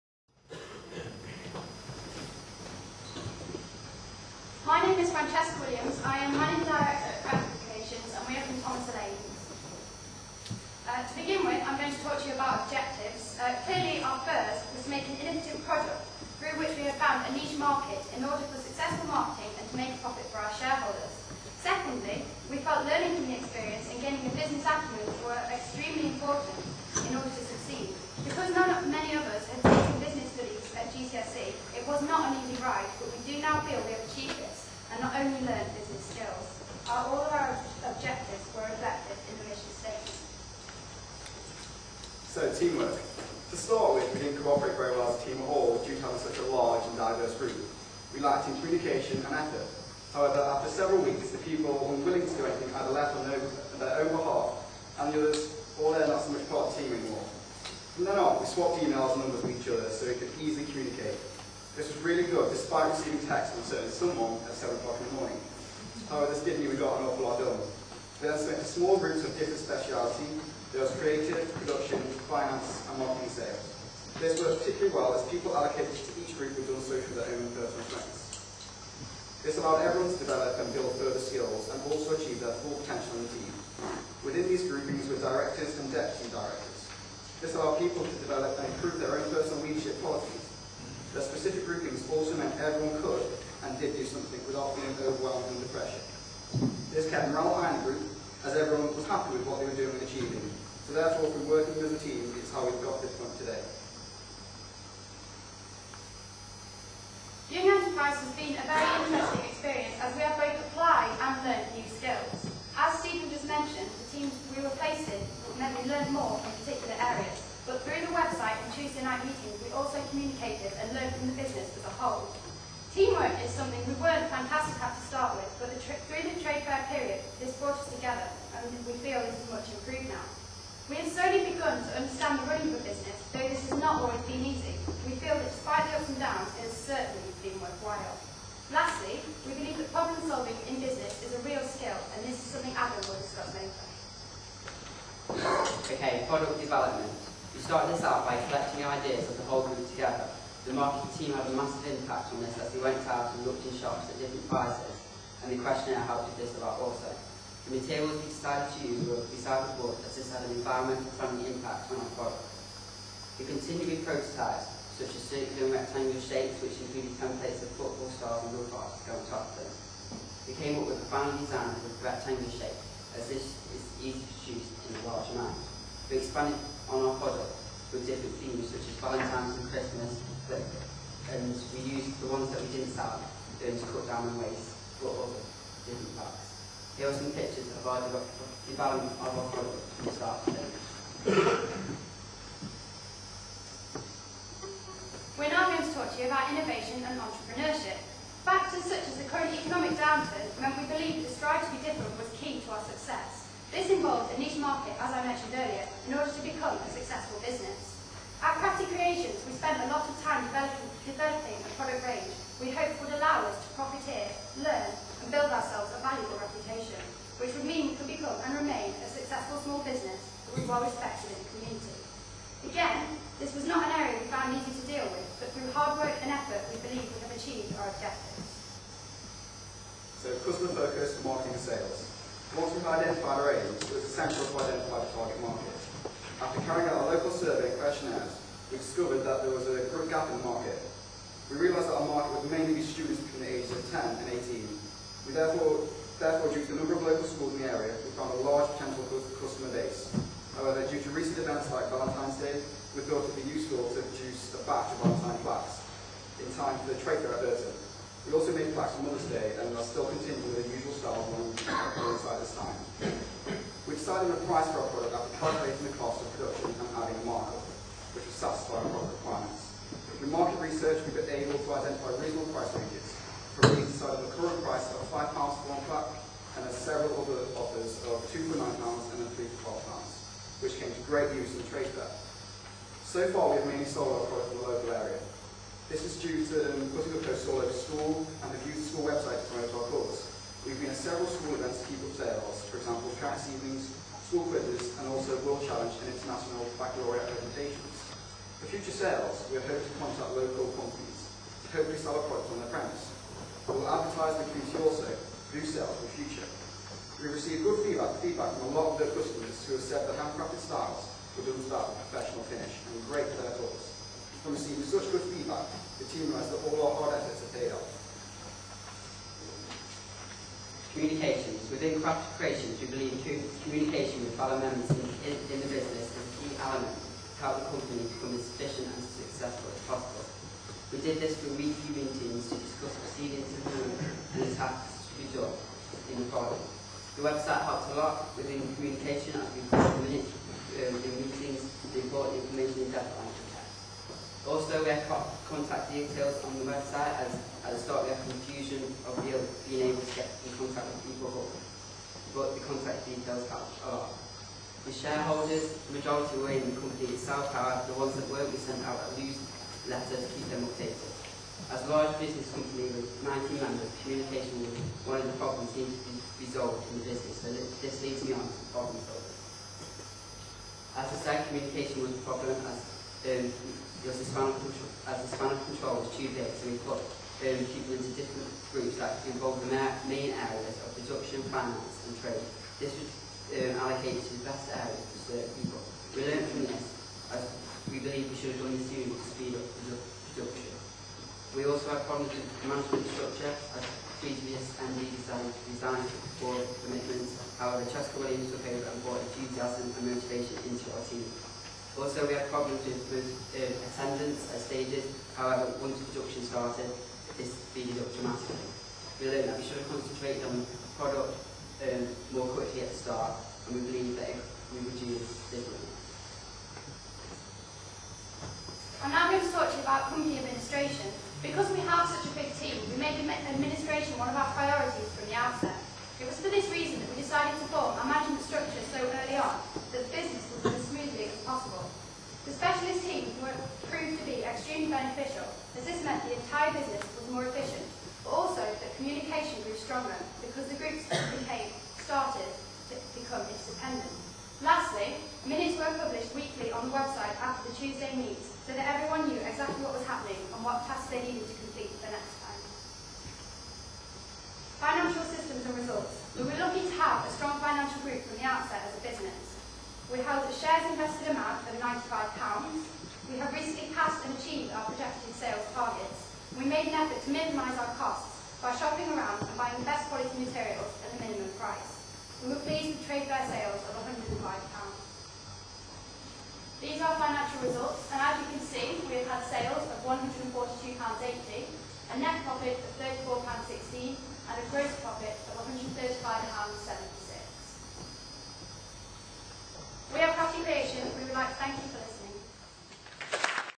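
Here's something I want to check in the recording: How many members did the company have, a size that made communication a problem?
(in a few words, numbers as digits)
19.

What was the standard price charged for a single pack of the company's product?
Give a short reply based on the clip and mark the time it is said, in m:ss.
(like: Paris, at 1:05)
£5, at 4:35.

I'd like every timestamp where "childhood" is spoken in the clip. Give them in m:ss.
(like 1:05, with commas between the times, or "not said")
not said.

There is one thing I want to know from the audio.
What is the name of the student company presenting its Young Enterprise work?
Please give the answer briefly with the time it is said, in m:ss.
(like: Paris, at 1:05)
Crafty Creations, at 3:28.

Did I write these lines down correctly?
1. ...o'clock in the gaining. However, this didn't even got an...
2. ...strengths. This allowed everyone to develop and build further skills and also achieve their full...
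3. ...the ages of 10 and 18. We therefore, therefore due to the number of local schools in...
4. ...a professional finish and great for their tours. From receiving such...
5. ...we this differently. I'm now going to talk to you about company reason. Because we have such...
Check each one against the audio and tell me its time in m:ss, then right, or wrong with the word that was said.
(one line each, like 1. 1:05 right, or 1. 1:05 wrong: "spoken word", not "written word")
1. 1:04 wrong: "morning", not "gaining"
2. 1:17 right
3. 4:03 right
4. 5:12 right
5. 6:54 wrong: "administration", not "reason".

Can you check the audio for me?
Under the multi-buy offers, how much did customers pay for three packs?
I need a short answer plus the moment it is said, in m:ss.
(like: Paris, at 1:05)
£12, at 4:39.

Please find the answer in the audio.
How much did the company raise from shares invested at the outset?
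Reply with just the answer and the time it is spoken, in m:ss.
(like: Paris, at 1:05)
£95, at 7:41.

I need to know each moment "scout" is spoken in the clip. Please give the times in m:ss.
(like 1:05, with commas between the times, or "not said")
not said.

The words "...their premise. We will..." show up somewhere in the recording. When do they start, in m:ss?
5:02.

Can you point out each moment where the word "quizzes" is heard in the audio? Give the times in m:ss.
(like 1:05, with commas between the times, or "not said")
4:54.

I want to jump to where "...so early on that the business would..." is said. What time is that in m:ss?
7:08.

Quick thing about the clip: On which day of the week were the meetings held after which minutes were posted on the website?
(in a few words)
Tuesday.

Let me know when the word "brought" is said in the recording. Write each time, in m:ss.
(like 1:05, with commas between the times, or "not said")
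2:07, 6:39.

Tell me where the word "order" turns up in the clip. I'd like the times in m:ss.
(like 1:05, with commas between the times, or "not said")
0:18, 0:27, 3:26.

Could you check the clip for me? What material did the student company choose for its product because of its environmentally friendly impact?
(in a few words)
Recycled wood.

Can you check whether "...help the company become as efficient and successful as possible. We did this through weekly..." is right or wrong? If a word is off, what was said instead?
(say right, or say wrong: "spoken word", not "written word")
right.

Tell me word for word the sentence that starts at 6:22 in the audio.
This was um, allocated to the best areas to serve people.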